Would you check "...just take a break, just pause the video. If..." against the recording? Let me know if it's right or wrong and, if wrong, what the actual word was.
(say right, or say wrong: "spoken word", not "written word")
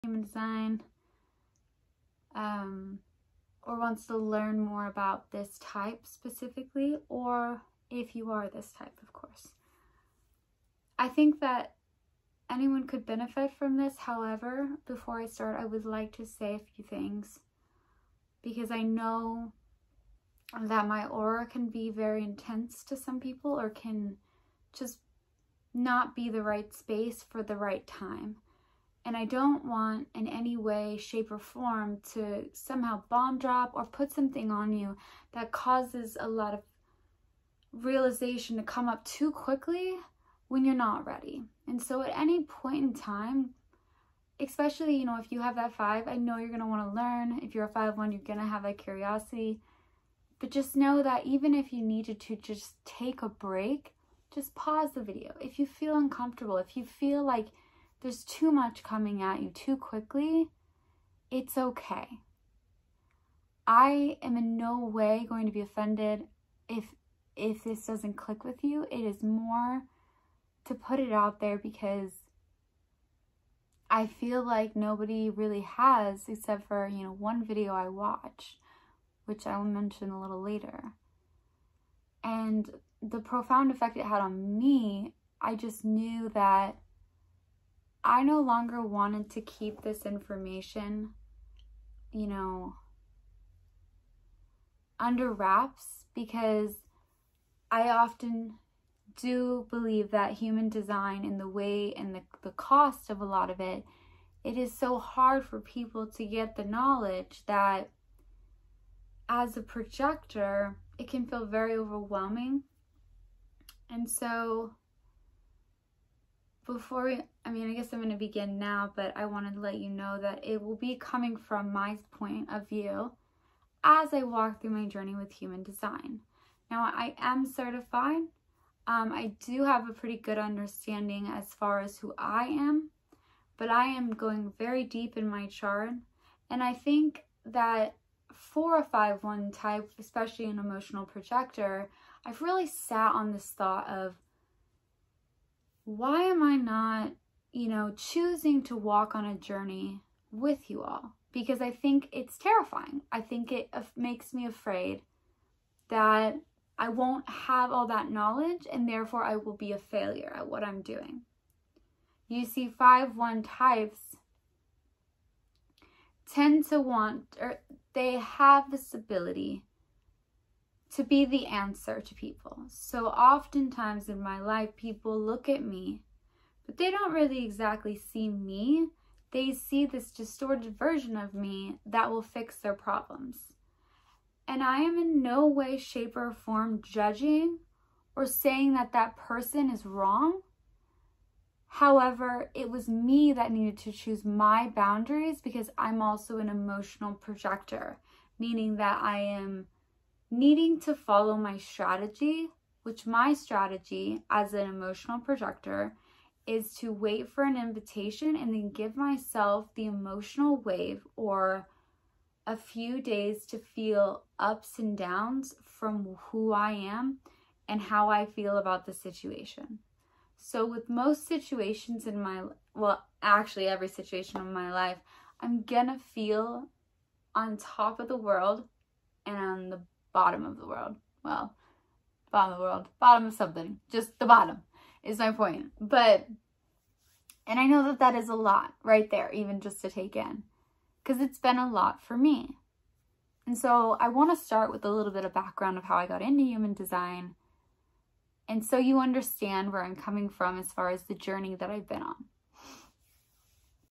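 right.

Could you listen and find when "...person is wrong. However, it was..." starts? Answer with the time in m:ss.
3:09.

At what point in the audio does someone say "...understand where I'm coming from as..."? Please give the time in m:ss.
4:08.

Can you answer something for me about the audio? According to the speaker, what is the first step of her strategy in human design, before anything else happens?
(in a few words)
Wait for an invitation.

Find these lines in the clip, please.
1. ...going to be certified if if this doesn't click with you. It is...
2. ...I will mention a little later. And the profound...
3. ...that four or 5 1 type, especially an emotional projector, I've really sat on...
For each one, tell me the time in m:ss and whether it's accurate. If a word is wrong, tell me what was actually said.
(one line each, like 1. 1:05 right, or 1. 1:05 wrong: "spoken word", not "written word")
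1. 1:05 wrong: "offended", not "certified"
2. 1:19 right
3. 2:17 right.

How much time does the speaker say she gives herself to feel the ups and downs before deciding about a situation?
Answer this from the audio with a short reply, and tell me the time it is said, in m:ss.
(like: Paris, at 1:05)
A few days, at 3:32.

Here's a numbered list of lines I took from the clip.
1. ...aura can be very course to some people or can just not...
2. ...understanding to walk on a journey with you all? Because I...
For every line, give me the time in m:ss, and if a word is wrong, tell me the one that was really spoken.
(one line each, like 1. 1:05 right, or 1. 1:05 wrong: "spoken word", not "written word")
1. 0:21 wrong: "intense", not "course"
2. 2:27 wrong: "choosing", not "understanding".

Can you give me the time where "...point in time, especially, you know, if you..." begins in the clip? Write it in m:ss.
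0:42.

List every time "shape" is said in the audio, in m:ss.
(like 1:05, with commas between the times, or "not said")
0:30, 3:05.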